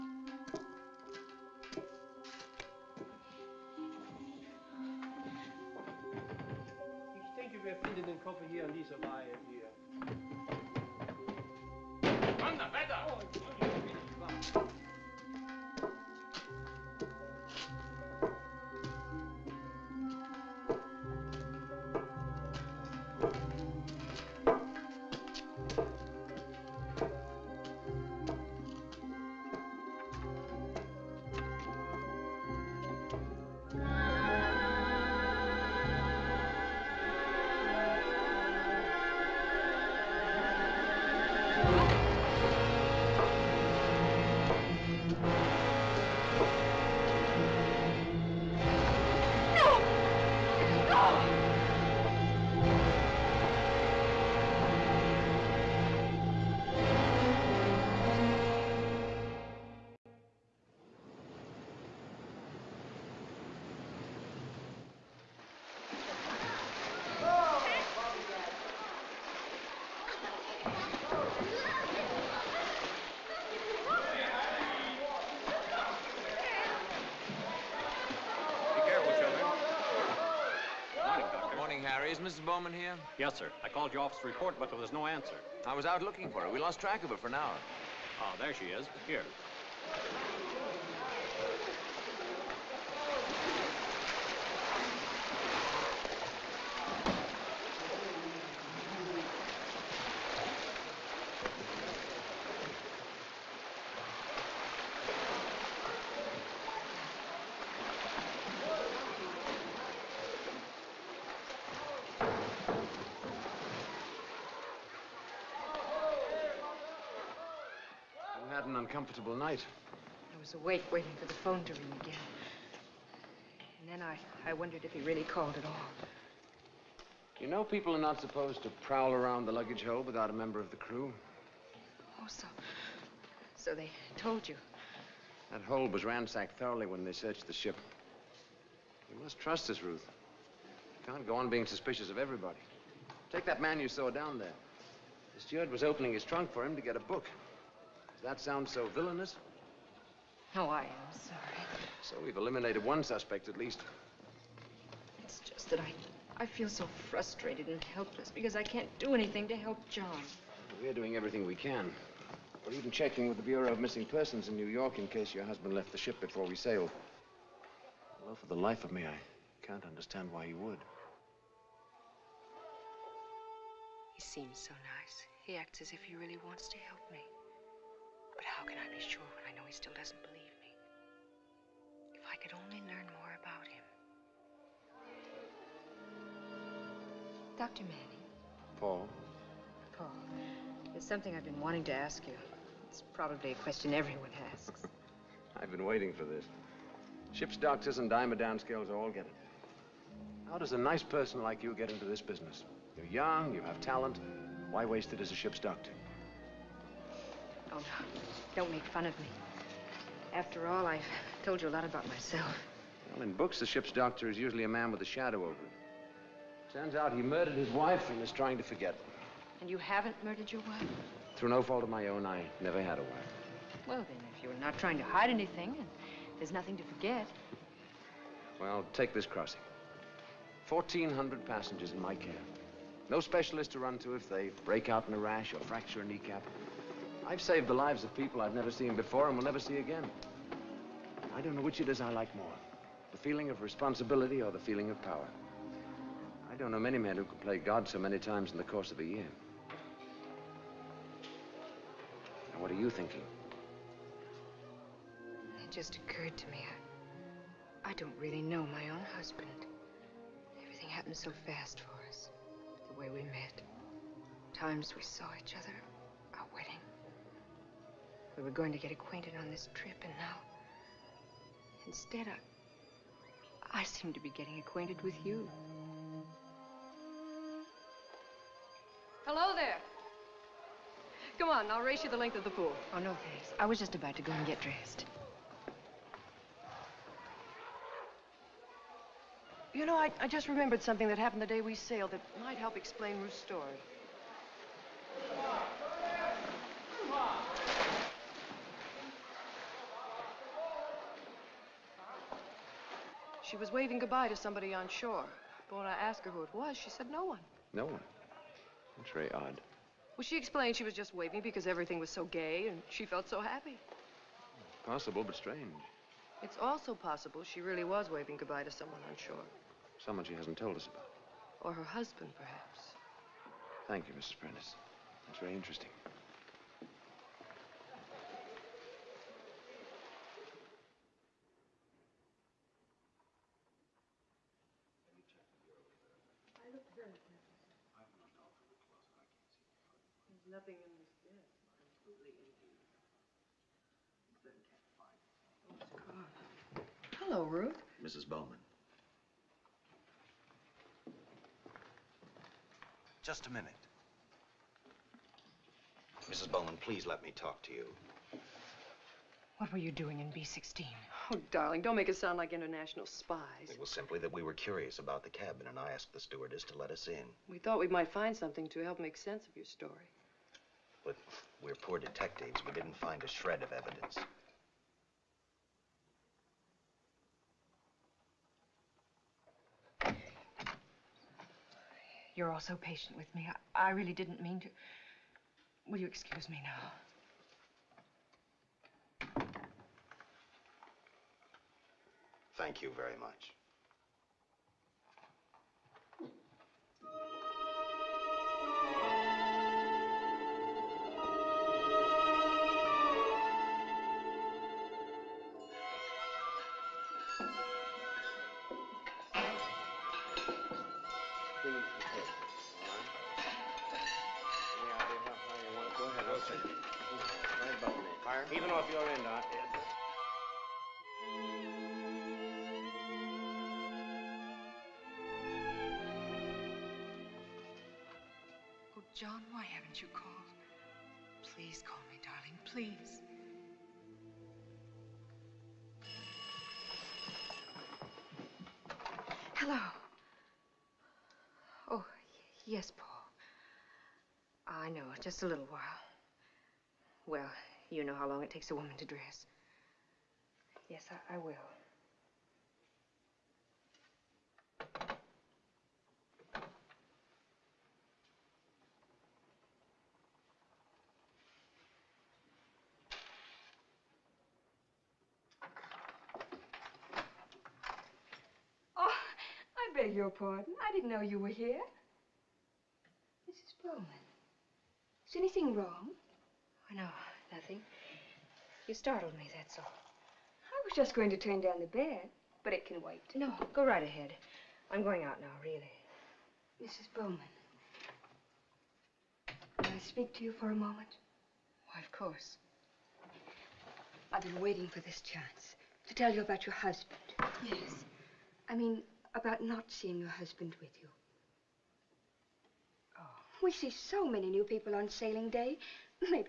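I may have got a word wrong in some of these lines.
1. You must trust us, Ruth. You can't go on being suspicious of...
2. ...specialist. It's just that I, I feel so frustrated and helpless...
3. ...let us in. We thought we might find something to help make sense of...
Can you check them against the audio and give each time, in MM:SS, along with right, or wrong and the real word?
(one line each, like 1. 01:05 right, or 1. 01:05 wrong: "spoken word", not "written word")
1. 02:19 right
2. 02:33 wrong: "least", not "specialist"
3. 06:06 right.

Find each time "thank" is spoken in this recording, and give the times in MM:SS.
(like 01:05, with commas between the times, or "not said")
04:43, 05:23, 06:32.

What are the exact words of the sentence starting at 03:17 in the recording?
Ship's doctors and Diamond scales all get it.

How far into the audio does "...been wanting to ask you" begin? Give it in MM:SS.
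03:11.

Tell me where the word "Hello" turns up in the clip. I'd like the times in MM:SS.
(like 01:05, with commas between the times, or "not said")
04:39, 07:19.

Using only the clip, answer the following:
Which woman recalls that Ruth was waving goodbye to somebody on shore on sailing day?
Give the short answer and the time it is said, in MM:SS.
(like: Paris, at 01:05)
Mrs. Prentice, at 05:24.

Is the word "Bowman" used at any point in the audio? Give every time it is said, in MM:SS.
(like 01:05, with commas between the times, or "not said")
01:22, 05:48, 05:56, 07:53, 08:07.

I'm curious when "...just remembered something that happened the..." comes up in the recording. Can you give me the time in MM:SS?
04:50.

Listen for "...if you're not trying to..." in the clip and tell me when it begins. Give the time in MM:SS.
03:44.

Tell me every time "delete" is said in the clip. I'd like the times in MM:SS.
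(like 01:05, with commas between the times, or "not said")
not said.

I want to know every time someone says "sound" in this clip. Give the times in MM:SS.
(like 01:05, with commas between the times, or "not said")
02:28, 06:02.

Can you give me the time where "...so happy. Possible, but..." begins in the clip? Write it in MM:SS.
05:13.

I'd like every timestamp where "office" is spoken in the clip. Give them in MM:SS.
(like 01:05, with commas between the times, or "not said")
01:24.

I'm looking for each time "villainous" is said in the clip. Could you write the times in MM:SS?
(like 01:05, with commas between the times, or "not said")
02:28.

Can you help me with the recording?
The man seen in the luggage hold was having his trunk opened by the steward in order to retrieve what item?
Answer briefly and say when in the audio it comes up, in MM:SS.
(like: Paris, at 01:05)
A book, at 02:26.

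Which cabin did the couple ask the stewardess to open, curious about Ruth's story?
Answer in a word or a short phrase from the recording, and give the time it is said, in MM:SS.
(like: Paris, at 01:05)
B-16, at 06:00.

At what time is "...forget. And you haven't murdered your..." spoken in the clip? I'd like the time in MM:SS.
03:38.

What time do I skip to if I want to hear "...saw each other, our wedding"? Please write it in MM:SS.
04:25.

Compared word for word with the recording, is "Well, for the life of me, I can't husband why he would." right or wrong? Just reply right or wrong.
wrong.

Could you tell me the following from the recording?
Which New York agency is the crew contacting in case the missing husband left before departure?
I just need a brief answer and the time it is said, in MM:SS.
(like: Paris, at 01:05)
Bureau of Missing Persons, at 02:43.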